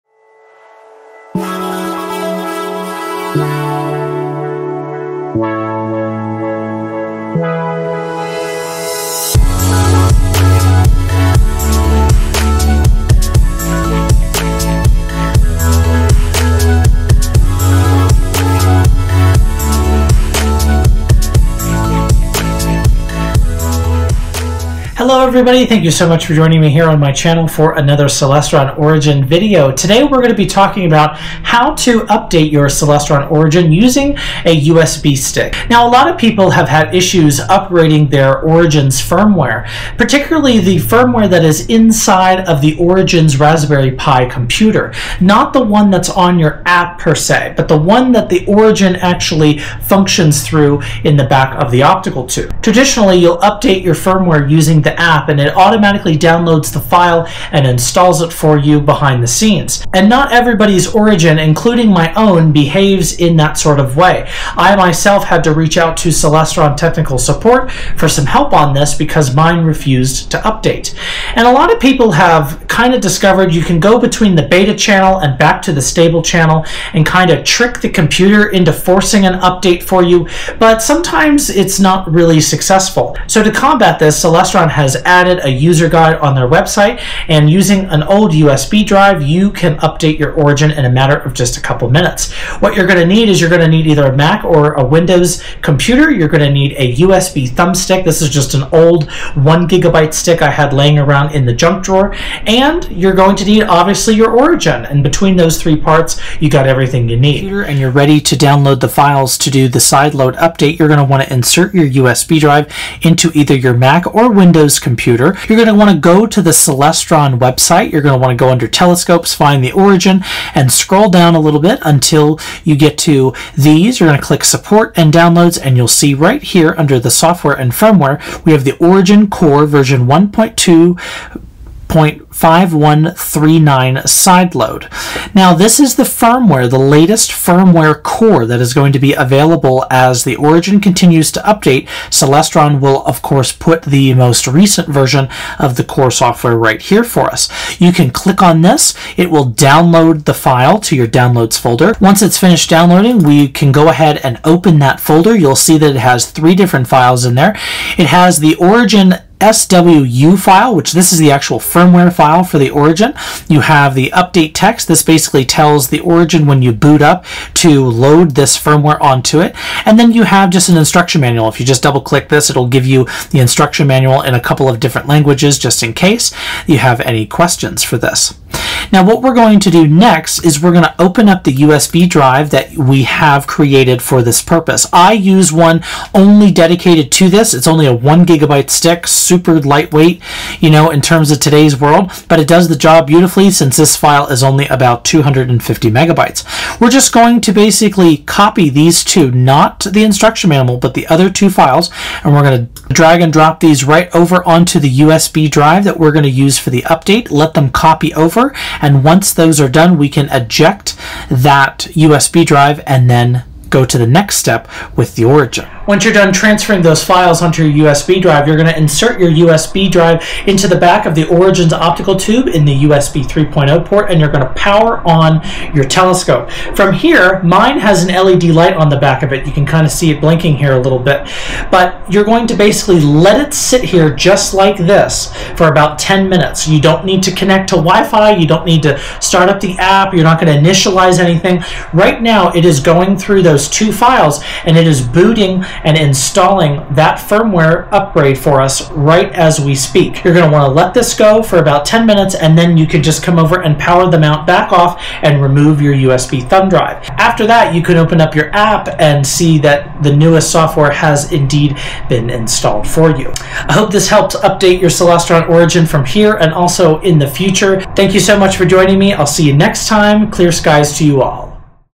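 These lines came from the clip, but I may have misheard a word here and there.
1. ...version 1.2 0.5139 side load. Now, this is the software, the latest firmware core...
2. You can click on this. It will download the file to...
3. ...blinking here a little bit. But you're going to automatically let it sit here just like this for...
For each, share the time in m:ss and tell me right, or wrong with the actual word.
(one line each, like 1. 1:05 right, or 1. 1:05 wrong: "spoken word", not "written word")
1. 2:09 wrong: "firmware", not "software"
2. 2:27 right
3. 3:50 wrong: "basically", not "automatically".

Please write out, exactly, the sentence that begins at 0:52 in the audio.
Traditionally you'll update your firmware using the app and it automatically downloads the file and installs it for you behind the scenes.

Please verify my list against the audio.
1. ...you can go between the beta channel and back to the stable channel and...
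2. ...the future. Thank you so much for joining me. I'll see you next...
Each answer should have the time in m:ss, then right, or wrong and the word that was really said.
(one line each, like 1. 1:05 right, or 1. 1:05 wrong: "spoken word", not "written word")
1. 1:13 right
2. 4:27 right.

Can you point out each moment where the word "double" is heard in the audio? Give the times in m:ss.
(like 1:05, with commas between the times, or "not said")
2:51.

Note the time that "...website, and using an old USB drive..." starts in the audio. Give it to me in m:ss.
1:26.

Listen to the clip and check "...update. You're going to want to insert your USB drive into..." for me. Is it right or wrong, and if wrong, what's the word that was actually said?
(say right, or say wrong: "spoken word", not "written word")
right.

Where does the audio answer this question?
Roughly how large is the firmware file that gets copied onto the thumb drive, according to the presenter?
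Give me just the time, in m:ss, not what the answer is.
3:15.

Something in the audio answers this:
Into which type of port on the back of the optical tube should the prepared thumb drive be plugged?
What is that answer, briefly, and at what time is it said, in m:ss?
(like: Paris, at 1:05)
USB 3.0, at 3:42.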